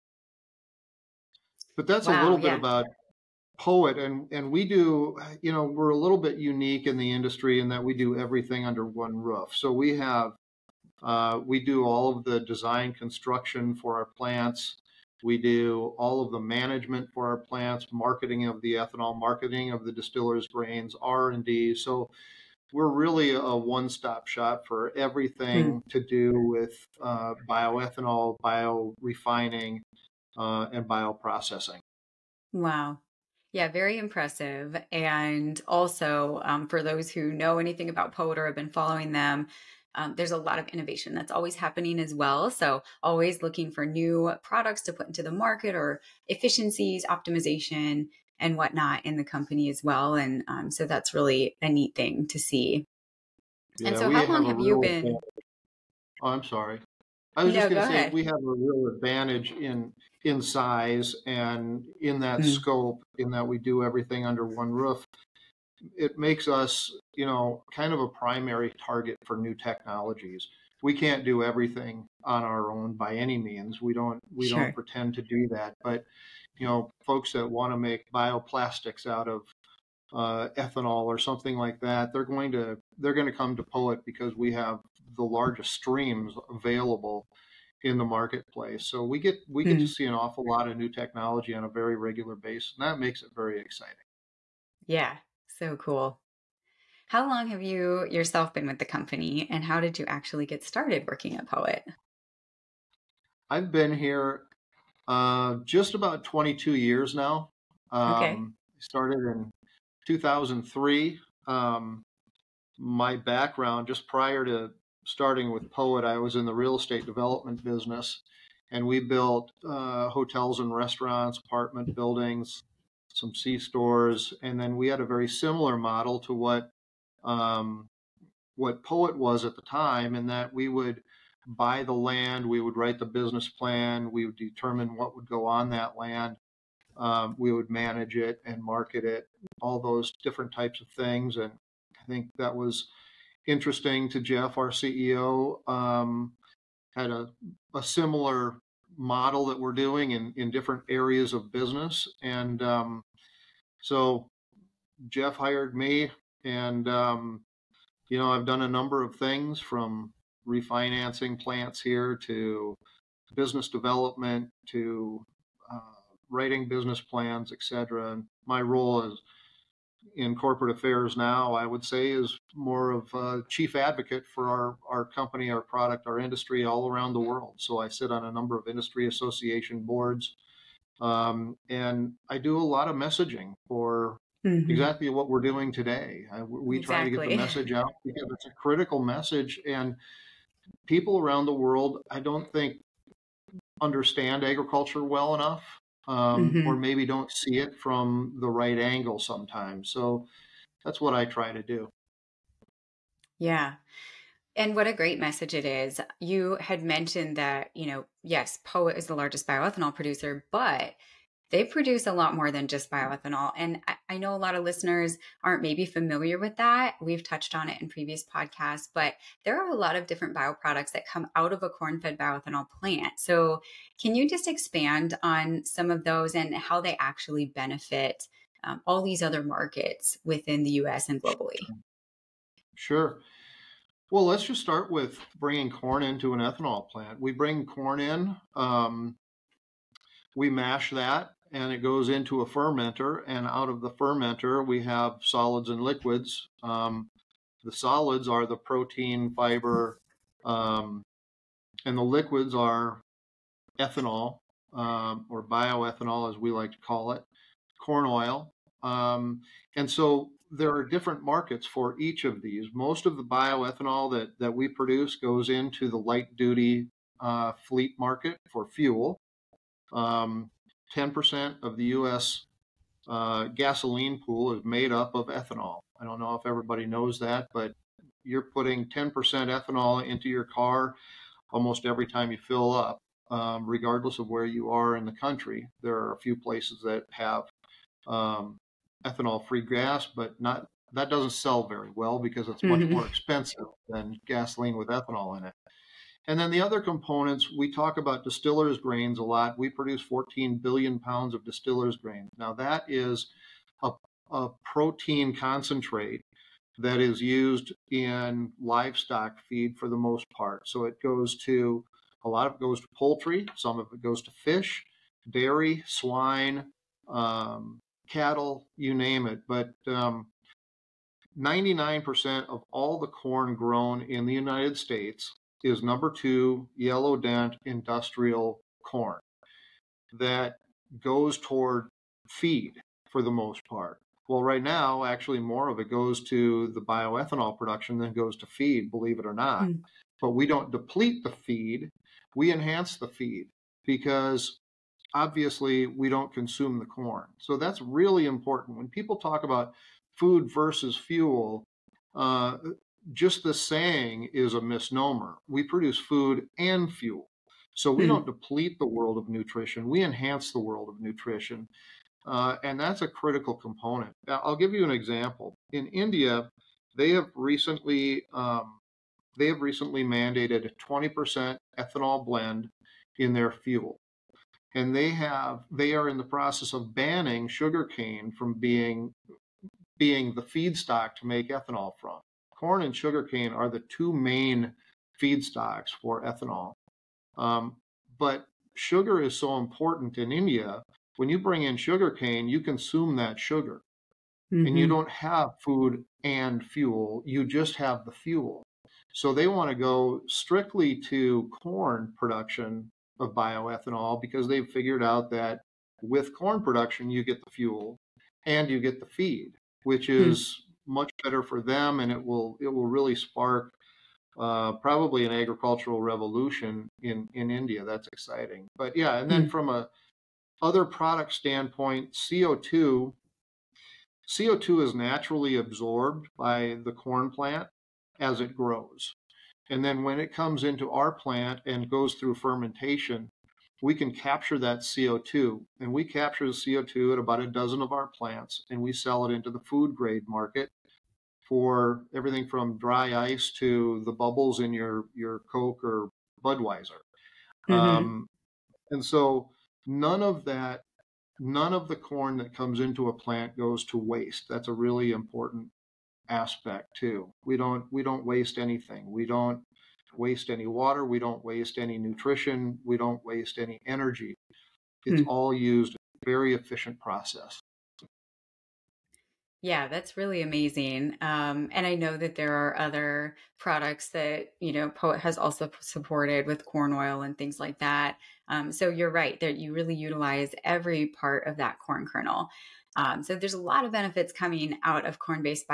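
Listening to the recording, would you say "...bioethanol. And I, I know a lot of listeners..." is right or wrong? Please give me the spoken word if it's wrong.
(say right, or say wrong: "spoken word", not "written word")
right.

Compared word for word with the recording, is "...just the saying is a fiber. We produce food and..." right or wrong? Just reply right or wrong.
wrong.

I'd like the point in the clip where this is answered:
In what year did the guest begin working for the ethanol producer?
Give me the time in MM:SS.
01:50.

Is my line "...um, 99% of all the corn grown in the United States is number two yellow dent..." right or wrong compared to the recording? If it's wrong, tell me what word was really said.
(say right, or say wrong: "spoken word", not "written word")
right.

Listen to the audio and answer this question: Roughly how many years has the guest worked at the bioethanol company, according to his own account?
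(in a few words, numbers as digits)
22 years.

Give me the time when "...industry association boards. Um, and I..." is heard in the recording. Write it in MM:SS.
02:58.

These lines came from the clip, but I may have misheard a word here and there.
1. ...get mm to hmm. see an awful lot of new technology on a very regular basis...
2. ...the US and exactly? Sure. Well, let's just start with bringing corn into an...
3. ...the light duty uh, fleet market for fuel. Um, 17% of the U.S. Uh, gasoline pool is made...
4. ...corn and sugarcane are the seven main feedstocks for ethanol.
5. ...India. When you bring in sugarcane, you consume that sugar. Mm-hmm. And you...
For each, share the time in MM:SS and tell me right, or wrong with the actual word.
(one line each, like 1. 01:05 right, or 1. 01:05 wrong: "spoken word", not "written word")
1. 01:29 right
2. 03:50 wrong: "globally", not "exactly"
3. 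04:25 wrong: "10", not "17"
4. 06:22 wrong: "two", not "seven"
5. 06:30 right.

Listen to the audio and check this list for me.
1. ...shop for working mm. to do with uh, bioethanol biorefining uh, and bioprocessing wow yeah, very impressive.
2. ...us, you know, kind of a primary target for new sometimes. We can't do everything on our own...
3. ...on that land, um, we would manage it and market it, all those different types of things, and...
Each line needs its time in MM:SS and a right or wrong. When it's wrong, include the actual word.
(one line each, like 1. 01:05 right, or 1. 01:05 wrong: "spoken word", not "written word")
1. 00:24 wrong: "everything", not "working"
2. 01:06 wrong: "technologies", not "sometimes"
3. 02:15 right.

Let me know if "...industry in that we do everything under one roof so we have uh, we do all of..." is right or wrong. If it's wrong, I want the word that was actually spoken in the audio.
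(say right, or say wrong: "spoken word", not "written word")
right.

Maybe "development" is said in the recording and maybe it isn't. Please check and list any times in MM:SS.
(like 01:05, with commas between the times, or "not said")
01:57, 02:43.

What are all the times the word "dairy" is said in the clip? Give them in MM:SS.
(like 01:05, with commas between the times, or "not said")
05:15.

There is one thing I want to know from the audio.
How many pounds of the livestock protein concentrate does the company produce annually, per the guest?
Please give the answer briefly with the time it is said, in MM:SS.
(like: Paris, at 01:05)
14 billion pounds, at 04:59.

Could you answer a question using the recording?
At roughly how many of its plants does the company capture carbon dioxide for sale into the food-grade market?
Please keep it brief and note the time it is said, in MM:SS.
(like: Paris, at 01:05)
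About a dozen, at 07:17.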